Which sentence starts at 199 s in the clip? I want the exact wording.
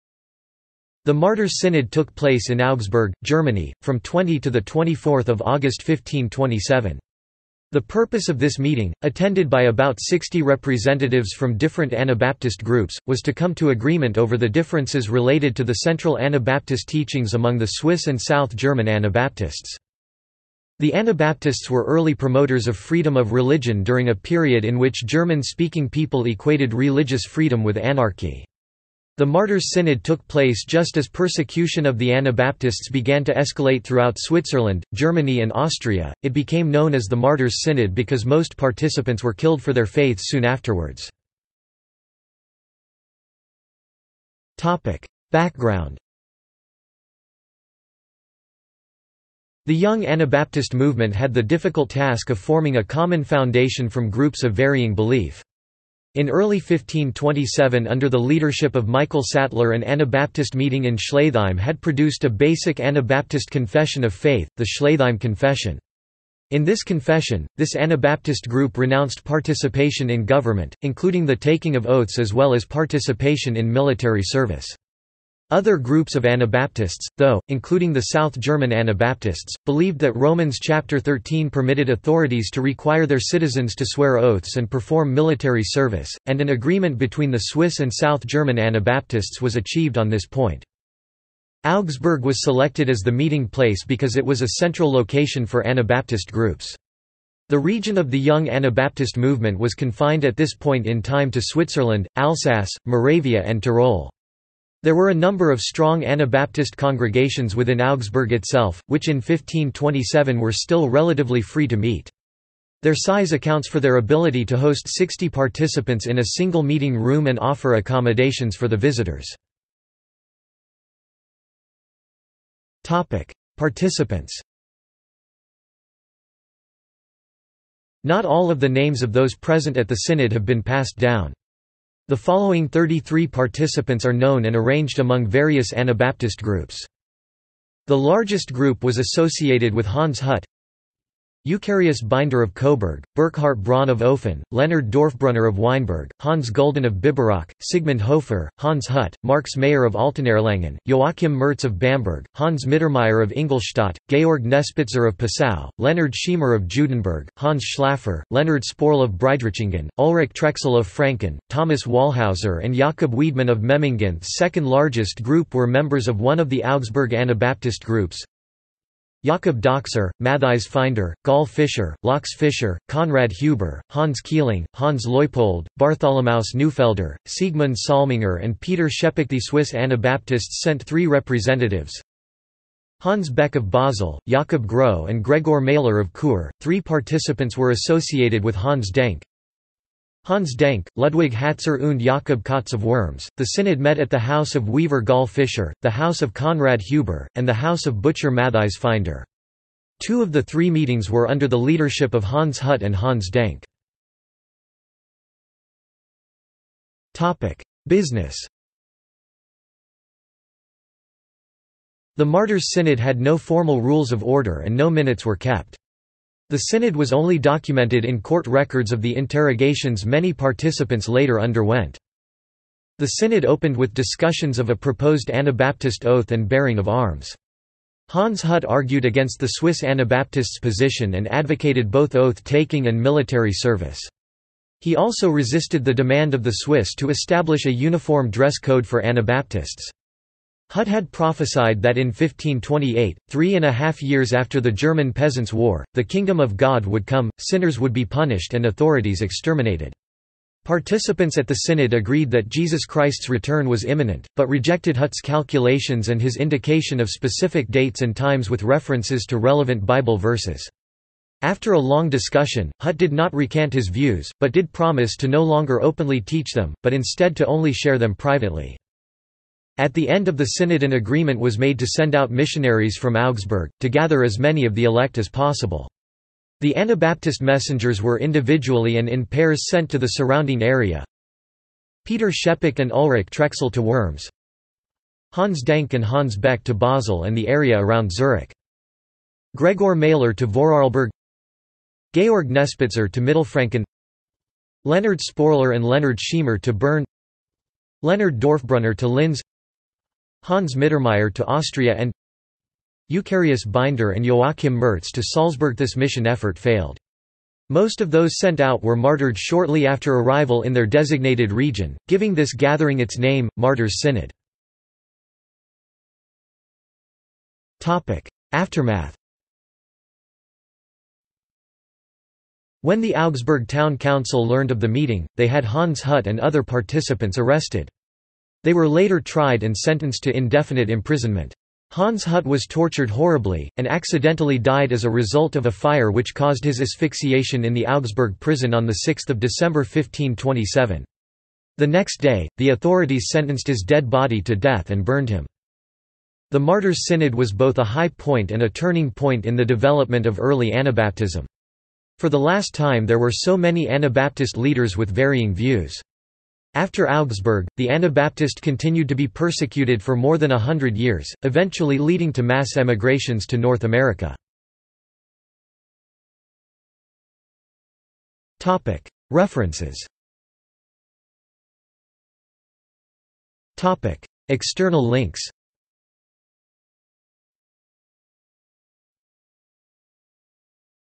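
Two of the three meetings were under the leadership of Hans Hut and Hans Denck.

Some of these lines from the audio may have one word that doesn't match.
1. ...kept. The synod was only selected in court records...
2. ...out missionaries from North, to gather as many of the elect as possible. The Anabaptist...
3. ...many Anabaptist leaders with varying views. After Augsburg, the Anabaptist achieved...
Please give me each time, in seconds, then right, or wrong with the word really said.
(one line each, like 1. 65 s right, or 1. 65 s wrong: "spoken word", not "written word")
1. 215 s wrong: "documented", not "selected"
2. 272 s wrong: "Augsburg", not "North"
3. 353 s wrong: "continued", not "achieved".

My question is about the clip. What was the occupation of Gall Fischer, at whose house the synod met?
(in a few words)
Weaver.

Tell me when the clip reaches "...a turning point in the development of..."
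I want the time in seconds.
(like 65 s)
348 s.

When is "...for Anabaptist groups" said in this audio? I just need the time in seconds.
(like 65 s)
95 s.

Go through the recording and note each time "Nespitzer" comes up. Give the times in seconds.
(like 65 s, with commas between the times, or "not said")
154 s, 292 s.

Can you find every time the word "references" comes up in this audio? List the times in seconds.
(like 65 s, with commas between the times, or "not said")
258 s, 369 s.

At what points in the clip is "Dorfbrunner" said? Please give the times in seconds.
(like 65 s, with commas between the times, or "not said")
144 s, 298 s.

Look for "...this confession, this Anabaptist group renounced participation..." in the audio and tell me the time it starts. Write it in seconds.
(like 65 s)
66 s.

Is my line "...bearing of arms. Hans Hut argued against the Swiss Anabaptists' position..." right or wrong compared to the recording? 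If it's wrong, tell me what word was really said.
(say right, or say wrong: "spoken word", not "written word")
right.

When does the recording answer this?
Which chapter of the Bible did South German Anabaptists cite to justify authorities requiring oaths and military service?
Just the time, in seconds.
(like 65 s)
80 s.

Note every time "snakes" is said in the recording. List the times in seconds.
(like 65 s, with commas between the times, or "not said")
not said.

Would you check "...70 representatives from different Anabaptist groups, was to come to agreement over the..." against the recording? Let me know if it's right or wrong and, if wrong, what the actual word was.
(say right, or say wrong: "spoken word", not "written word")
wrong: "60", not "70".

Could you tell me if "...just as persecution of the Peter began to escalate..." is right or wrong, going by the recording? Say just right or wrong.
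wrong.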